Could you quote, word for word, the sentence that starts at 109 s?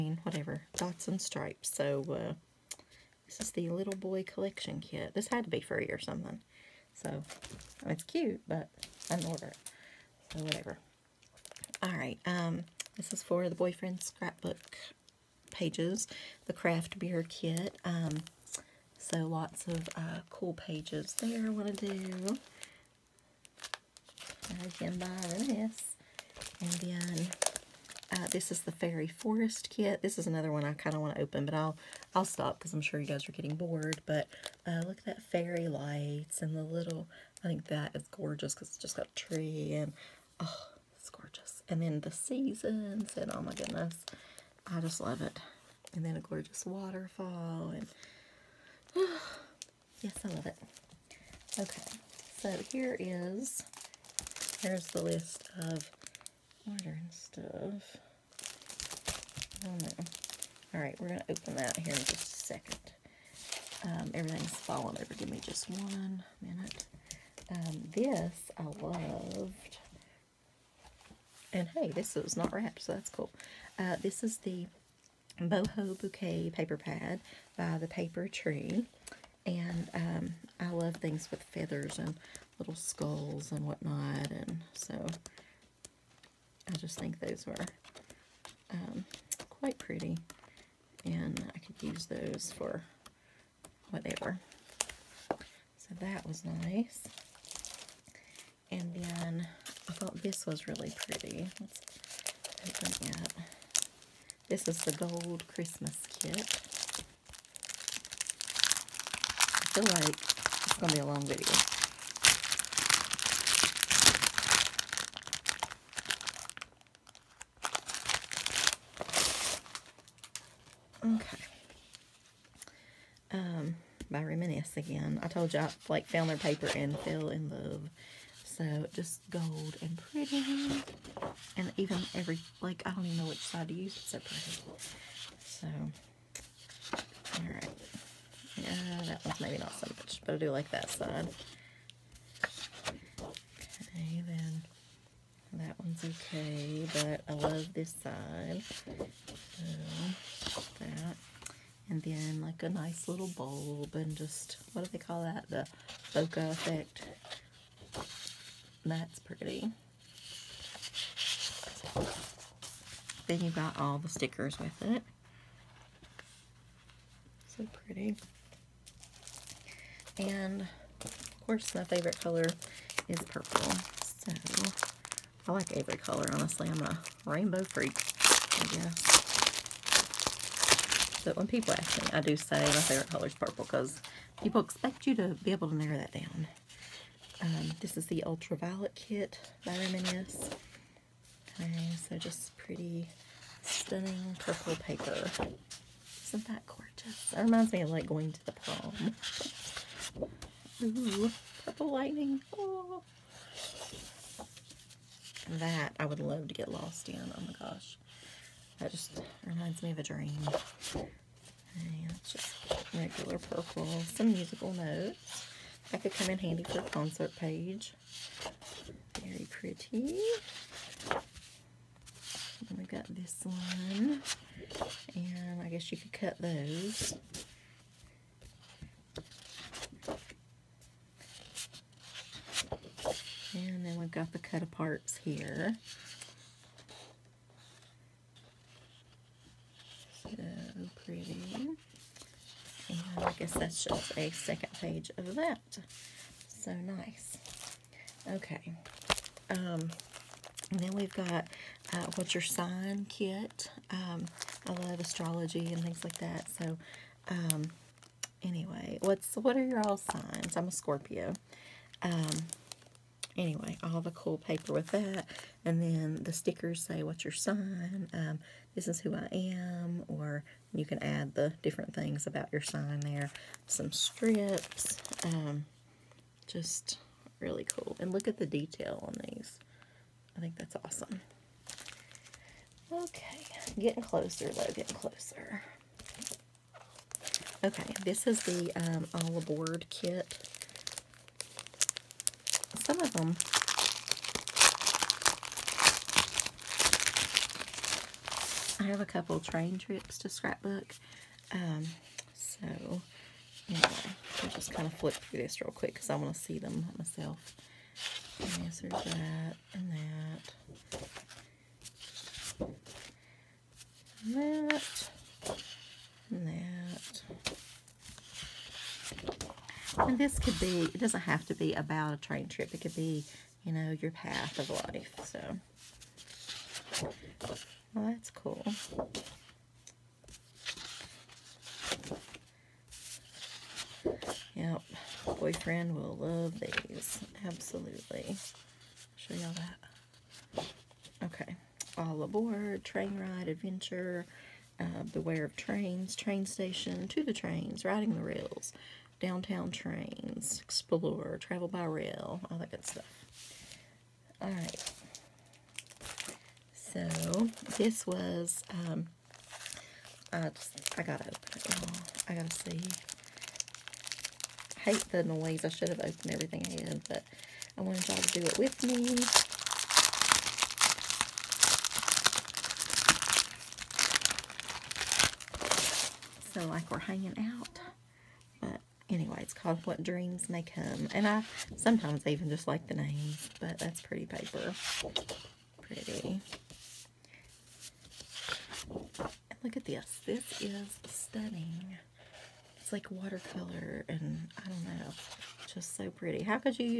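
I feel like it's going to be a long video.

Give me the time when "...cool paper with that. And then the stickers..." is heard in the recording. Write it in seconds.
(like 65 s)
264 s.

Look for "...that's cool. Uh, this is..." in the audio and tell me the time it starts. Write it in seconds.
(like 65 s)
72 s.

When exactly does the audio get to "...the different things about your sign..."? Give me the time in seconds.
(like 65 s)
271 s.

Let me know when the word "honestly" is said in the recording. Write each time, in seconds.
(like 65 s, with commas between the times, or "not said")
176 s.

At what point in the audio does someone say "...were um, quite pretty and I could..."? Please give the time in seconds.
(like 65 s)
87 s.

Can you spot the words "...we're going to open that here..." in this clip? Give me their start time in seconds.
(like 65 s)
61 s.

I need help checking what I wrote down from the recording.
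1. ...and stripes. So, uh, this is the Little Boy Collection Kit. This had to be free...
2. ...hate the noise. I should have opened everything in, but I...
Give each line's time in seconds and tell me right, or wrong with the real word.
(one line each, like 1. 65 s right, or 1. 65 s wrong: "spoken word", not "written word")
1. 1 s right
2. 364 s right.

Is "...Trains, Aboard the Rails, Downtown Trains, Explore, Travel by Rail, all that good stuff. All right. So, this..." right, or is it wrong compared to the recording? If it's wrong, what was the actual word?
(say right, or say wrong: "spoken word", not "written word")
wrong: "Riding", not "Aboard".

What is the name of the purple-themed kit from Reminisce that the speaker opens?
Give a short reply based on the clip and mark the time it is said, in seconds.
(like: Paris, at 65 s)
Ultraviolet kit, at 188 s.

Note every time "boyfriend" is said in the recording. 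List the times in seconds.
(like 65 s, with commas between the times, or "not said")
13 s, 335 s.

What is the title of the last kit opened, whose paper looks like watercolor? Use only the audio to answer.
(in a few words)
What Dreams May Come.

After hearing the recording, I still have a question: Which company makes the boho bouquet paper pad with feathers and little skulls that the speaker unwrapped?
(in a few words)
The Paper Tree.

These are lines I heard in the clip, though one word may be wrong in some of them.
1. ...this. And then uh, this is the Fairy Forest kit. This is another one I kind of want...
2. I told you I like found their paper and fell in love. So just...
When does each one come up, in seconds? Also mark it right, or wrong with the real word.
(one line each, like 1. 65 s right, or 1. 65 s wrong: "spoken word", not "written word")
1. 25 s right
2. 125 s right.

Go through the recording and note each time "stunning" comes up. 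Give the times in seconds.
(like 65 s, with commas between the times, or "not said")
193 s, 391 s.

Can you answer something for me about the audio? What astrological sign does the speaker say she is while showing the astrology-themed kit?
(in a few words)
Scorpio.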